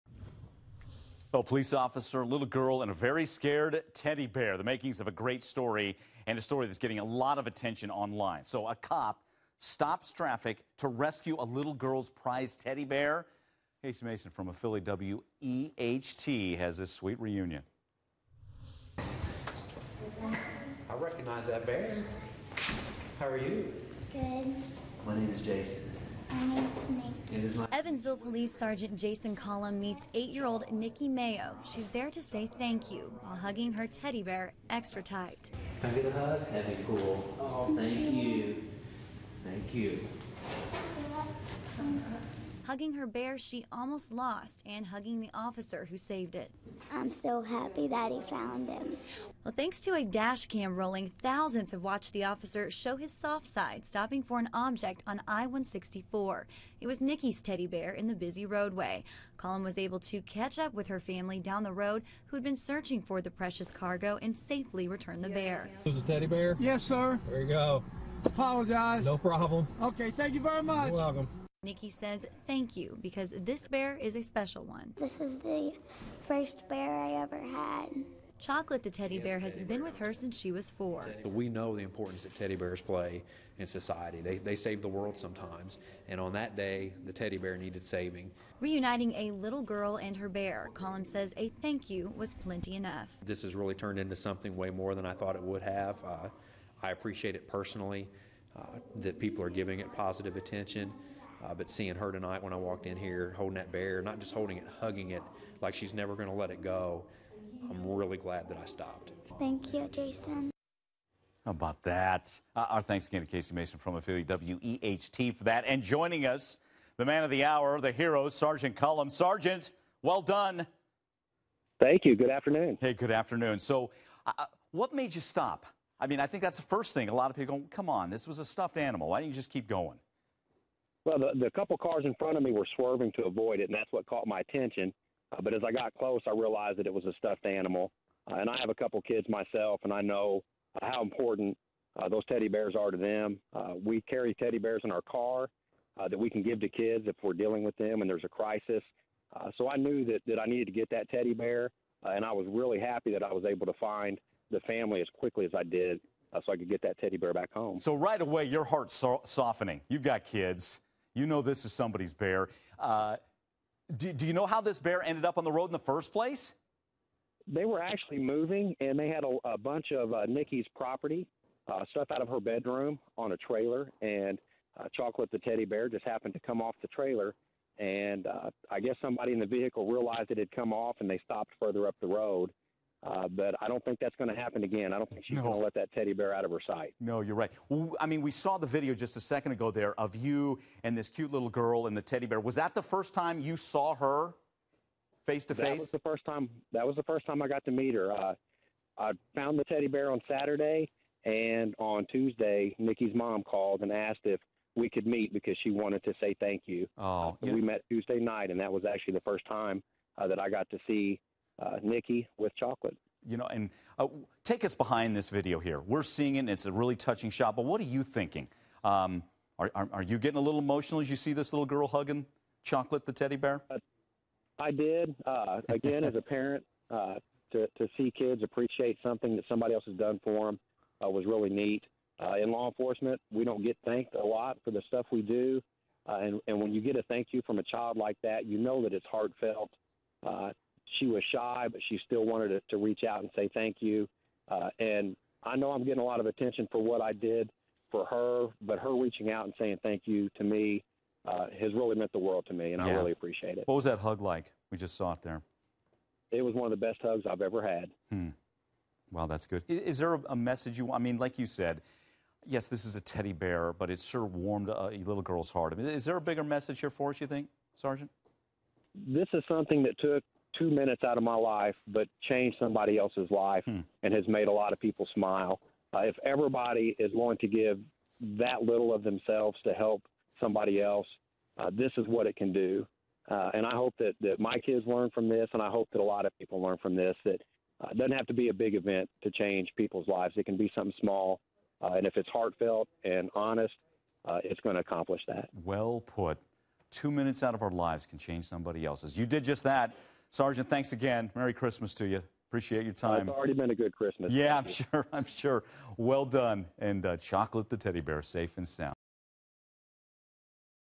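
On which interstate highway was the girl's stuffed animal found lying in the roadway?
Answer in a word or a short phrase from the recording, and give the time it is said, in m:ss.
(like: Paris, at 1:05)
I-164, at 0:55.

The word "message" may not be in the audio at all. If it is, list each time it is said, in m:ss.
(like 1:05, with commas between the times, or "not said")
4:20, 4:26.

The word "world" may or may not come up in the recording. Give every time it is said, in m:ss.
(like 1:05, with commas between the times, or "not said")
1:24, 4:12.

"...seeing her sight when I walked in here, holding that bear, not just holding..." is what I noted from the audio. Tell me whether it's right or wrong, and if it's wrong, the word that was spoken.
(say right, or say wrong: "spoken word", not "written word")
wrong: "tonight", not "sight".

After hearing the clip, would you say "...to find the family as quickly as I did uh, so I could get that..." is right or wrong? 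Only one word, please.
right.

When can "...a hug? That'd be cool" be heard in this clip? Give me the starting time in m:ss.
0:36.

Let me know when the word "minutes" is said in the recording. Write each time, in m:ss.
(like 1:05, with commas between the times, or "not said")
4:30, 4:57.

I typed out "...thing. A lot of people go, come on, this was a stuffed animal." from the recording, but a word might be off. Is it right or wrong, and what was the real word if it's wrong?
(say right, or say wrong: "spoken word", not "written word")
right.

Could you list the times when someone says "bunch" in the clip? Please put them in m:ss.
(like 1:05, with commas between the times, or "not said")
2:49.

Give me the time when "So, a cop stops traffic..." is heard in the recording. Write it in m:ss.
0:08.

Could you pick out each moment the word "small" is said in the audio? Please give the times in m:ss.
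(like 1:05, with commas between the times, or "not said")
4:50.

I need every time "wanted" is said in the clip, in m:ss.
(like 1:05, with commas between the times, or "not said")
3:25, 4:02.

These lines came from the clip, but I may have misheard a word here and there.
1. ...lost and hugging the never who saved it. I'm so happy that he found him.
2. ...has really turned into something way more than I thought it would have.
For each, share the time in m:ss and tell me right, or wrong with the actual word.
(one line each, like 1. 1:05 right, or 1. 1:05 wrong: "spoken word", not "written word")
1. 0:44 wrong: "officer", not "never"
2. 1:33 right.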